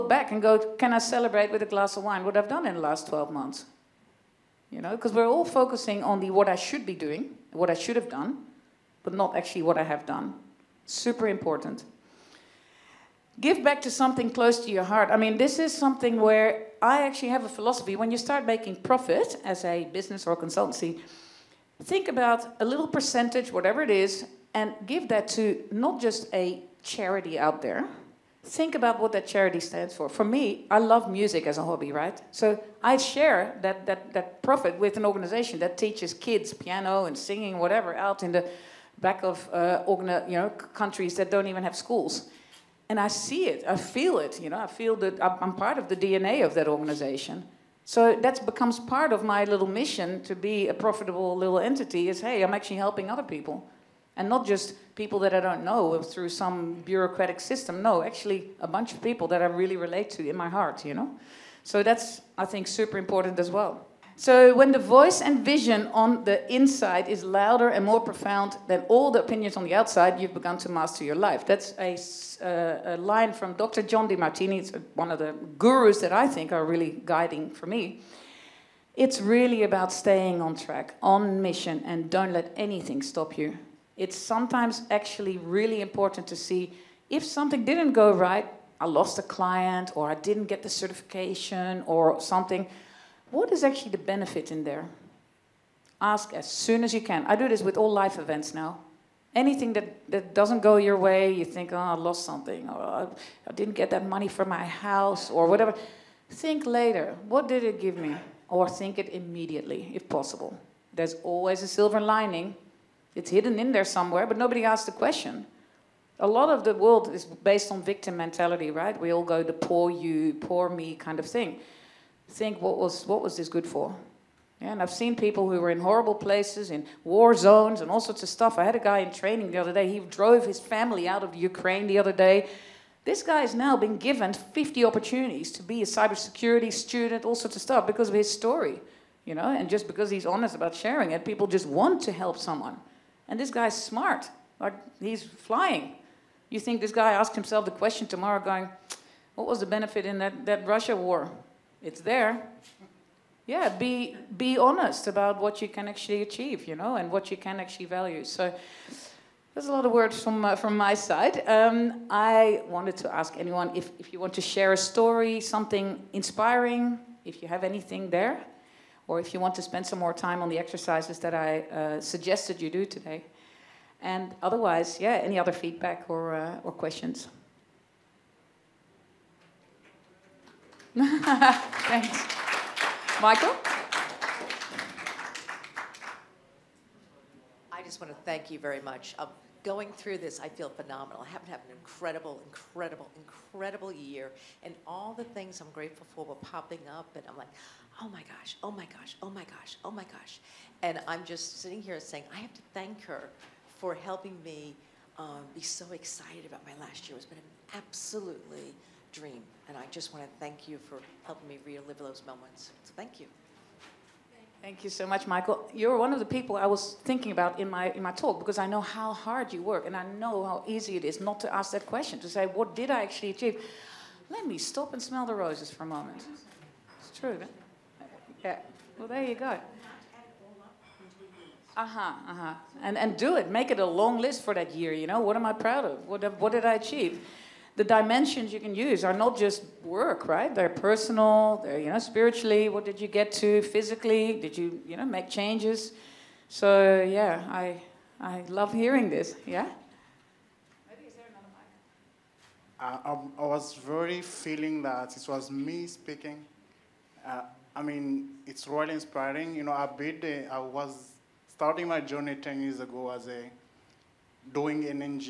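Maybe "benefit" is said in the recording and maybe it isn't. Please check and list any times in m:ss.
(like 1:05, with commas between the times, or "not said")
1:33, 2:29.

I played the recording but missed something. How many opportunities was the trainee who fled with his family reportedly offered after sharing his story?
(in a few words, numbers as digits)
50.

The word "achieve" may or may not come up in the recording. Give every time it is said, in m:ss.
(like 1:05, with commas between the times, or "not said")
2:36, 3:43, 3:56.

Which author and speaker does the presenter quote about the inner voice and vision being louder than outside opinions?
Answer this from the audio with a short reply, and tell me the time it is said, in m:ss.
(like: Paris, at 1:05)
Dr. John Demartini, at 1:13.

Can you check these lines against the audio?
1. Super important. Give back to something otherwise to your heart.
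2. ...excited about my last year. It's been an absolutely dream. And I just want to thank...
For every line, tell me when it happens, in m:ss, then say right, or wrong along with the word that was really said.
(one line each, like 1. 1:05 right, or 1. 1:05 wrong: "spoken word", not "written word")
1. 0:10 wrong: "close", not "otherwise"
2. 3:25 right.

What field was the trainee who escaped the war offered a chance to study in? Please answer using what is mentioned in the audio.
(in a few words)
cybersecurity.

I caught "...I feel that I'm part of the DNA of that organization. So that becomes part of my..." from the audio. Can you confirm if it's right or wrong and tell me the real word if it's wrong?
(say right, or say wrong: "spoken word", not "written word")
right.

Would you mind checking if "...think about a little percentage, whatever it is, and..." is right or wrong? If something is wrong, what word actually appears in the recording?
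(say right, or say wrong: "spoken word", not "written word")
right.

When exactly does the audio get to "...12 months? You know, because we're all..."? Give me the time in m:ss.
0:03.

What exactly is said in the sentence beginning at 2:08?
I had a guy in training the other day.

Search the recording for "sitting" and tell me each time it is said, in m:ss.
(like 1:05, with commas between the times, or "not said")
3:21.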